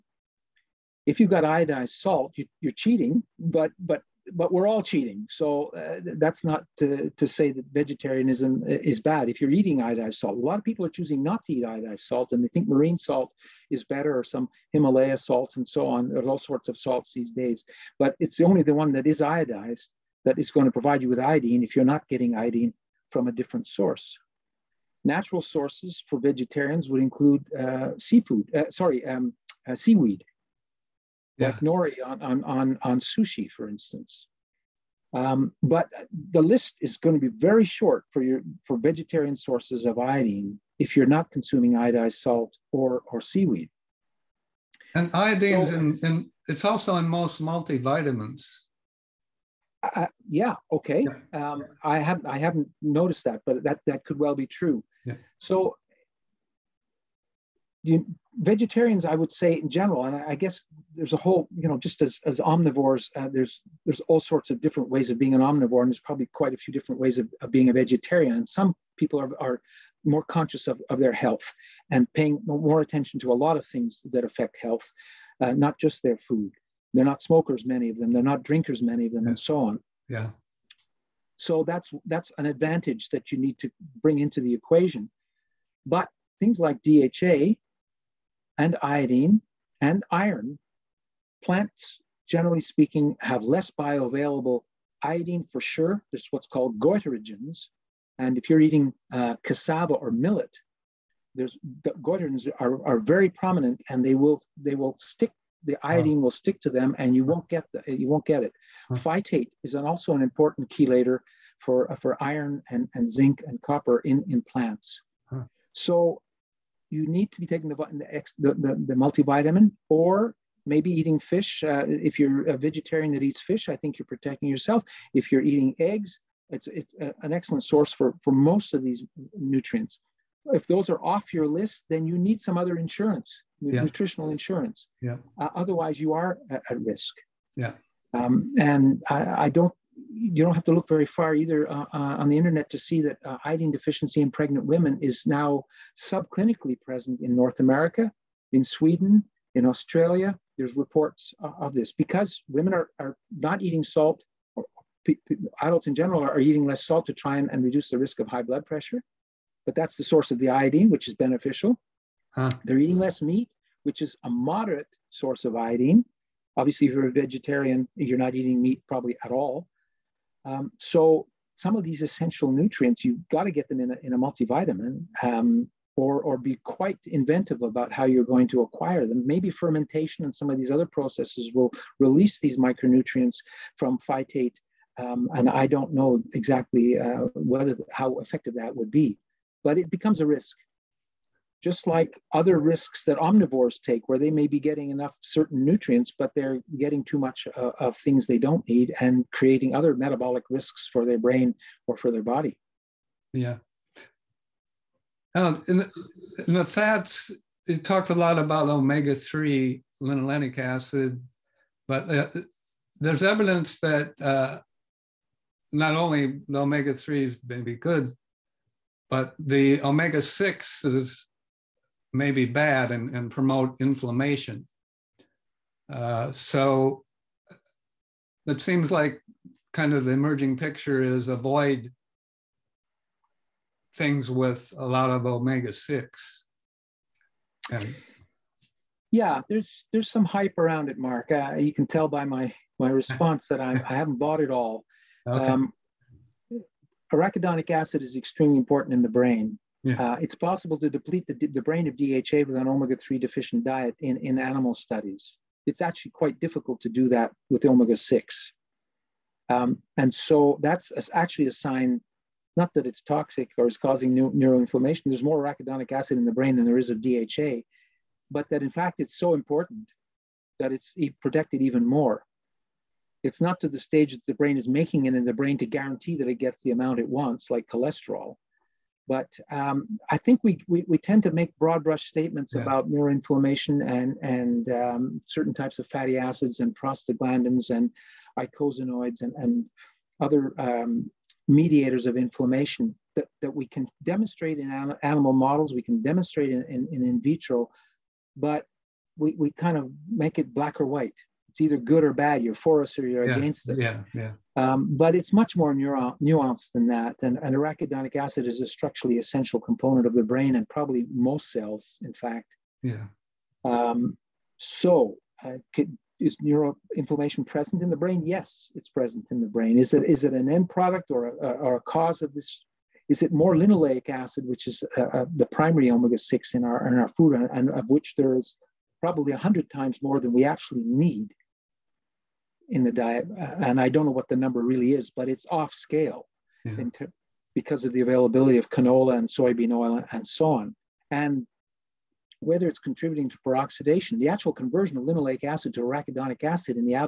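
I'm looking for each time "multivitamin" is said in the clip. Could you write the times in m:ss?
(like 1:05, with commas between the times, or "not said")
0:47, 1:58, 2:54.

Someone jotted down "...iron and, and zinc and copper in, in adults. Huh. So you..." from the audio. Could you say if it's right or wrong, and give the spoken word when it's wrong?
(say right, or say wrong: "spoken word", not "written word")
wrong: "plants", not "adults".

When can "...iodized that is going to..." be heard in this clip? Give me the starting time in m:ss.
0:19.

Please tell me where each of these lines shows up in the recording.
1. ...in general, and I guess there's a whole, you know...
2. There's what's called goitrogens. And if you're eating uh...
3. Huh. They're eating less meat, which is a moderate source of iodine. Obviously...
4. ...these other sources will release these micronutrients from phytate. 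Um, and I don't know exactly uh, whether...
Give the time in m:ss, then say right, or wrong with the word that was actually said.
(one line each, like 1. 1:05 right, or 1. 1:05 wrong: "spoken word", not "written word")
1. 0:59 right
2. 1:36 right
3. 2:42 right
4. 3:00 wrong: "processes", not "sources".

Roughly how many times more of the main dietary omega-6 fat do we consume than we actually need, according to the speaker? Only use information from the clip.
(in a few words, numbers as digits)
100 times.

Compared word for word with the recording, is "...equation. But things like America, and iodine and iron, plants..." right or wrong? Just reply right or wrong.
wrong.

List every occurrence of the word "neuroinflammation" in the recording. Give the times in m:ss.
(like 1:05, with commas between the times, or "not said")
4:24, 4:42, 5:16.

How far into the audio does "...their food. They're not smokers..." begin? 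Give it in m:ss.
1:16.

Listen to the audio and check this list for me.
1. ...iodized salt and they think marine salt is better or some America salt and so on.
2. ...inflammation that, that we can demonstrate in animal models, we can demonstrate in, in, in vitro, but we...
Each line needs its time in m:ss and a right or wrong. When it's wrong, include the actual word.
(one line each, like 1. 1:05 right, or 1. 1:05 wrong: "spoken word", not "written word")
1. 0:11 wrong: "Himalaya", not "America"
2. 4:52 right.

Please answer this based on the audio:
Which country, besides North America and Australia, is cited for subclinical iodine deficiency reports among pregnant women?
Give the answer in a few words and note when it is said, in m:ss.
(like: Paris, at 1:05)
Sweden, at 2:28.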